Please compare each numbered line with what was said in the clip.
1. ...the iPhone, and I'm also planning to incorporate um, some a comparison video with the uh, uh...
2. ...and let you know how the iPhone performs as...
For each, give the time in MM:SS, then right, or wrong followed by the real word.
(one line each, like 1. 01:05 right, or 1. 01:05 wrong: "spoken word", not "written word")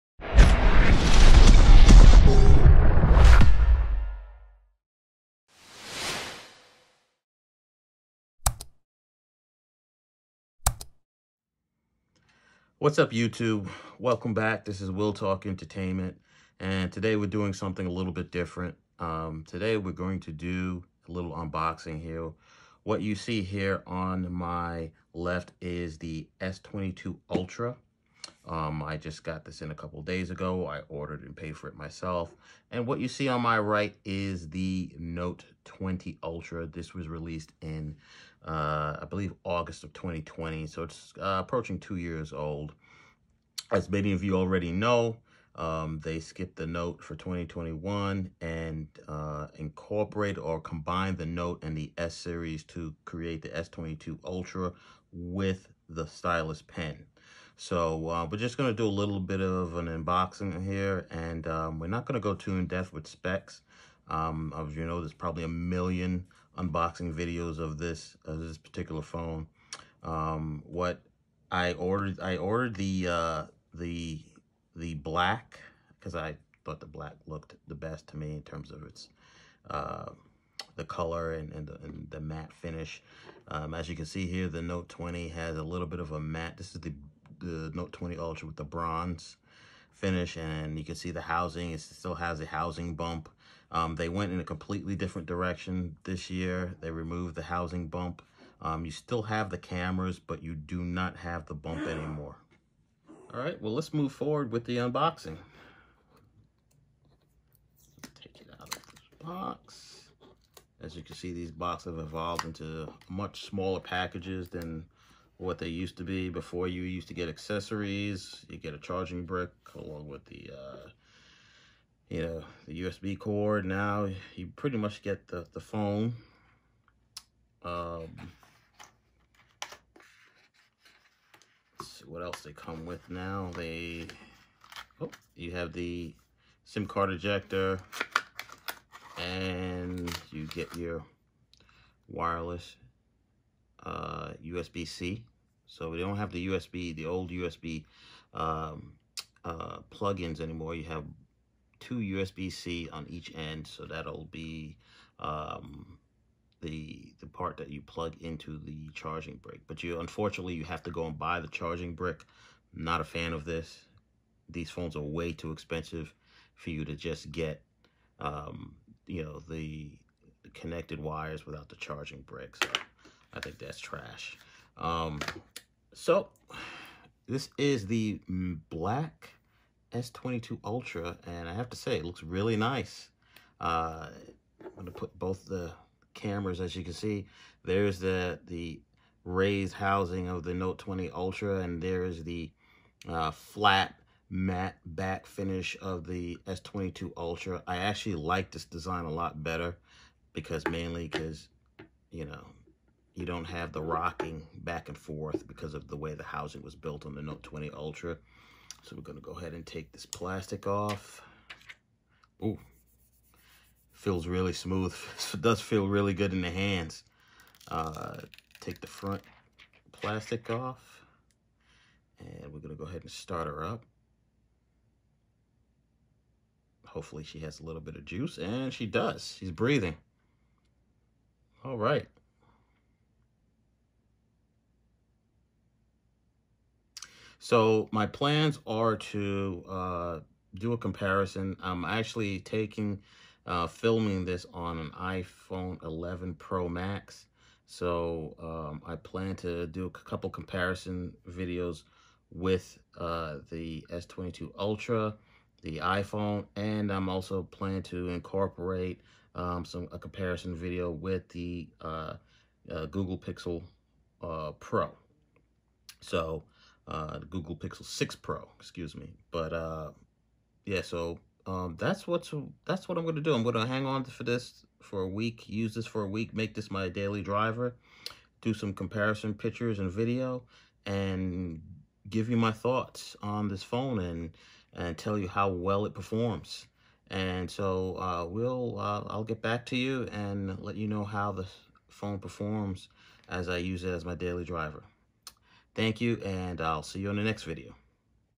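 1. 04:15 right
2. 04:50 wrong: "phone", not "iPhone".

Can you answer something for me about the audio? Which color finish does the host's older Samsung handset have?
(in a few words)
bronze.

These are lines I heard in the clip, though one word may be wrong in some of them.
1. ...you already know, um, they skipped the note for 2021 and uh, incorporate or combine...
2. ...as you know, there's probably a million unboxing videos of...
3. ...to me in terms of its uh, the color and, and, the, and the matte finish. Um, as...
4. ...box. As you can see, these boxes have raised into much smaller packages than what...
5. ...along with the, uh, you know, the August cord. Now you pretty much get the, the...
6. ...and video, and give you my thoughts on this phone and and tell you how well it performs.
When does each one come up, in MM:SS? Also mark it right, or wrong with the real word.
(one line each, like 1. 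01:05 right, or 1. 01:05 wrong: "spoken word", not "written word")
1. 00:44 right
2. 01:04 right
3. 01:18 right
4. 01:49 wrong: "evolved", not "raised"
5. 01:59 wrong: "USB", not "August"
6. 04:39 right.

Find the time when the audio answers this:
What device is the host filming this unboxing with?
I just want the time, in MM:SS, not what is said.
04:04.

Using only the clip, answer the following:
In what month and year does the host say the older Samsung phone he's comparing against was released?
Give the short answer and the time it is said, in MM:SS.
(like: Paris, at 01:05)
August 2020, at 00:39.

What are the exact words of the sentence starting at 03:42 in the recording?
And we're gonna go ahead and start her up.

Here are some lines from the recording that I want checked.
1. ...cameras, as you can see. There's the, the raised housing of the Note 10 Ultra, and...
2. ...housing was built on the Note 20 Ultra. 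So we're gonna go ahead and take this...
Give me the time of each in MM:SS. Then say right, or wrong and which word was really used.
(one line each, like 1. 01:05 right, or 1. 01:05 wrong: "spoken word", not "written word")
1. 03:06 wrong: "20", not "10"
2. 03:26 right.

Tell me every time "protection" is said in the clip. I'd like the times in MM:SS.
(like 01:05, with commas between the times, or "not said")
not said.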